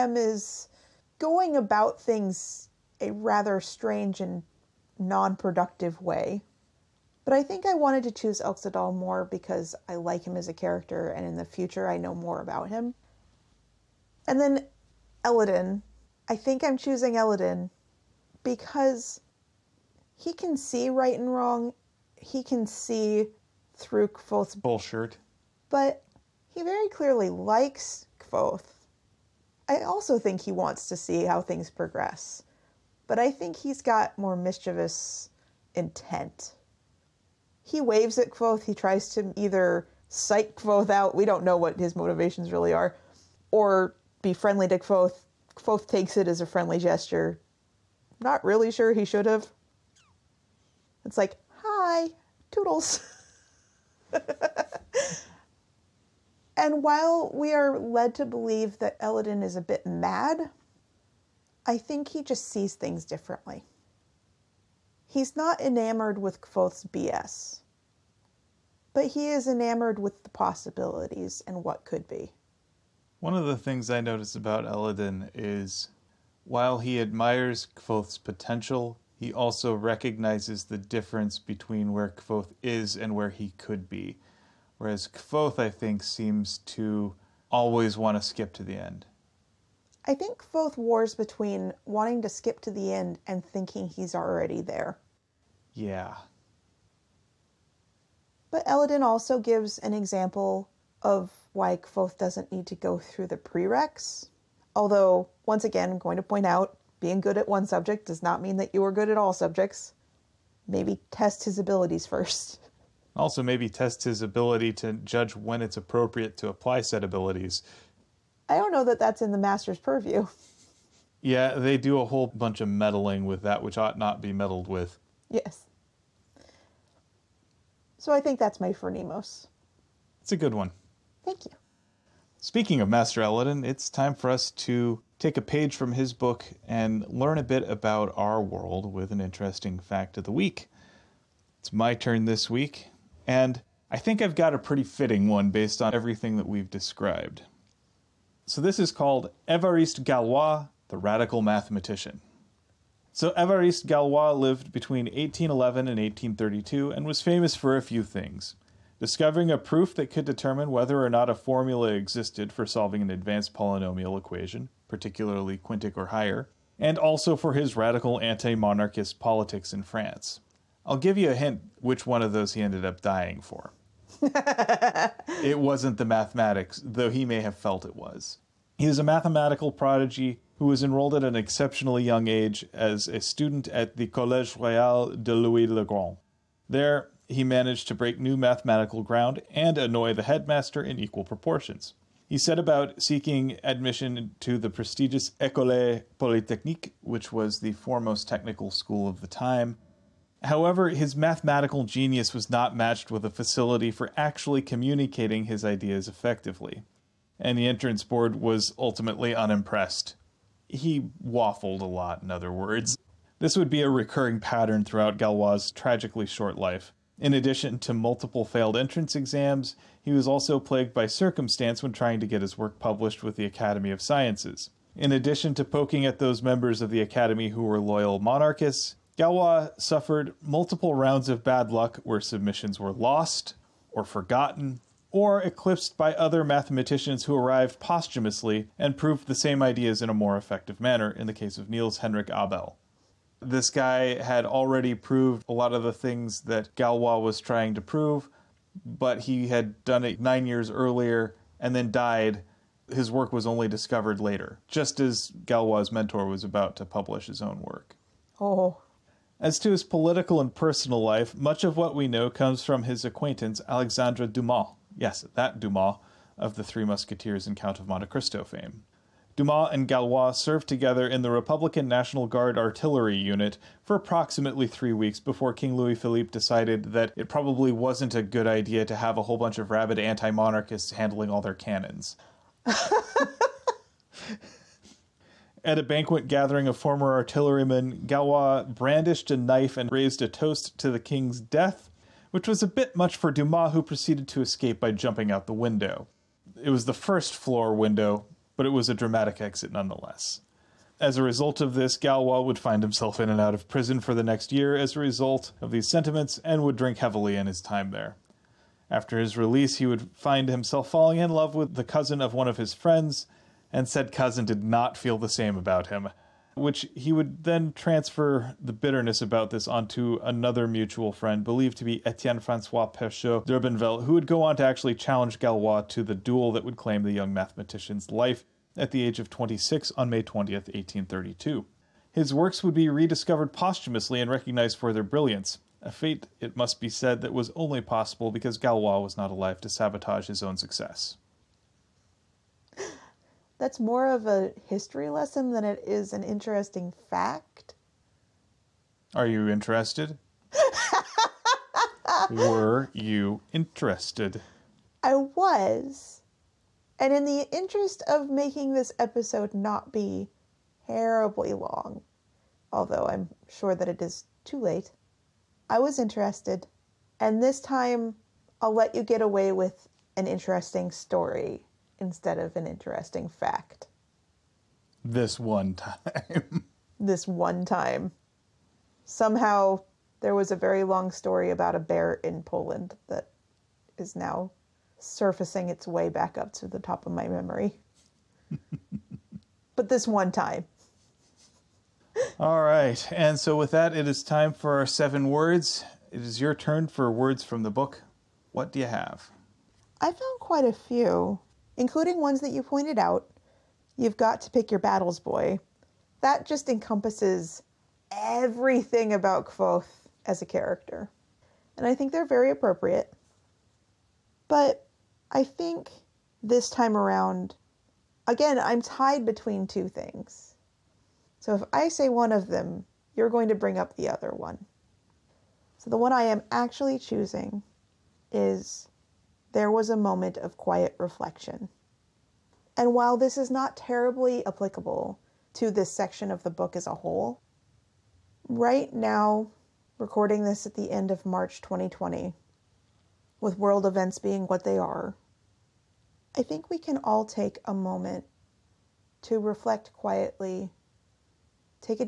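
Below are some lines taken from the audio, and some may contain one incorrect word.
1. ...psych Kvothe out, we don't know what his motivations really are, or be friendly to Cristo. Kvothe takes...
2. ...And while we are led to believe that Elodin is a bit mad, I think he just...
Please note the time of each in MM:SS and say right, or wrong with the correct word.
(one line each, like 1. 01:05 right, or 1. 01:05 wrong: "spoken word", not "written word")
1. 00:40 wrong: "Kvothe", not "Cristo"
2. 00:56 right.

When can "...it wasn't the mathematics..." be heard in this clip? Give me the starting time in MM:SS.
02:55.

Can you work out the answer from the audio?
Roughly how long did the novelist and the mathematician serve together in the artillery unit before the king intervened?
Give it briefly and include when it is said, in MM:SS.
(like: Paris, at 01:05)
Three weeks, at 04:34.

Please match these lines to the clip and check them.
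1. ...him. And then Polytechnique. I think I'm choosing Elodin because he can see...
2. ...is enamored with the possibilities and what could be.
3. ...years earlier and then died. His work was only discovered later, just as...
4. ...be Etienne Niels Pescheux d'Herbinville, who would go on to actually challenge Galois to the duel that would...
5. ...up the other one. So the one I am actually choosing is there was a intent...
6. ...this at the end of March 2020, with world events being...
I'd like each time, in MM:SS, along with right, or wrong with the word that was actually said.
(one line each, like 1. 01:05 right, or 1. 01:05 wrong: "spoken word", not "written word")
1. 00:12 wrong: "Elodin", not "Polytechnique"
2. 01:09 right
3. 04:10 right
4. 05:21 wrong: "Francois", not "Niels"
5. 07:03 wrong: "moment", not "intent"
6. 07:20 right.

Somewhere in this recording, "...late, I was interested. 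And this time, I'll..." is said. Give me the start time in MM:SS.
06:04.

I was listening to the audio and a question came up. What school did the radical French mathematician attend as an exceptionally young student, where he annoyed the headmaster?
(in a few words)
Collège Royal de Louis le Grand.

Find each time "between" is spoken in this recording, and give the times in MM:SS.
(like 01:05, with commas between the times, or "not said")
01:21, 01:31, 02:34, 06:59.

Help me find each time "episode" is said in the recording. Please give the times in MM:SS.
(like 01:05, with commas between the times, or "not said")
05:58.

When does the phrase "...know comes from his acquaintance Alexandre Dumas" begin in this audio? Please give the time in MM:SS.
04:22.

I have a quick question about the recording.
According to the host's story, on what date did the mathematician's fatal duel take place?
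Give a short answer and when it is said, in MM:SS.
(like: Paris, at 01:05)
May 20th, 1832, at 05:30.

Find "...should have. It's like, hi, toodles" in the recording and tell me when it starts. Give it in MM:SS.
00:49.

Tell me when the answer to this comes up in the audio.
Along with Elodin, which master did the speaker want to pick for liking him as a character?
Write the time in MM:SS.
00:08.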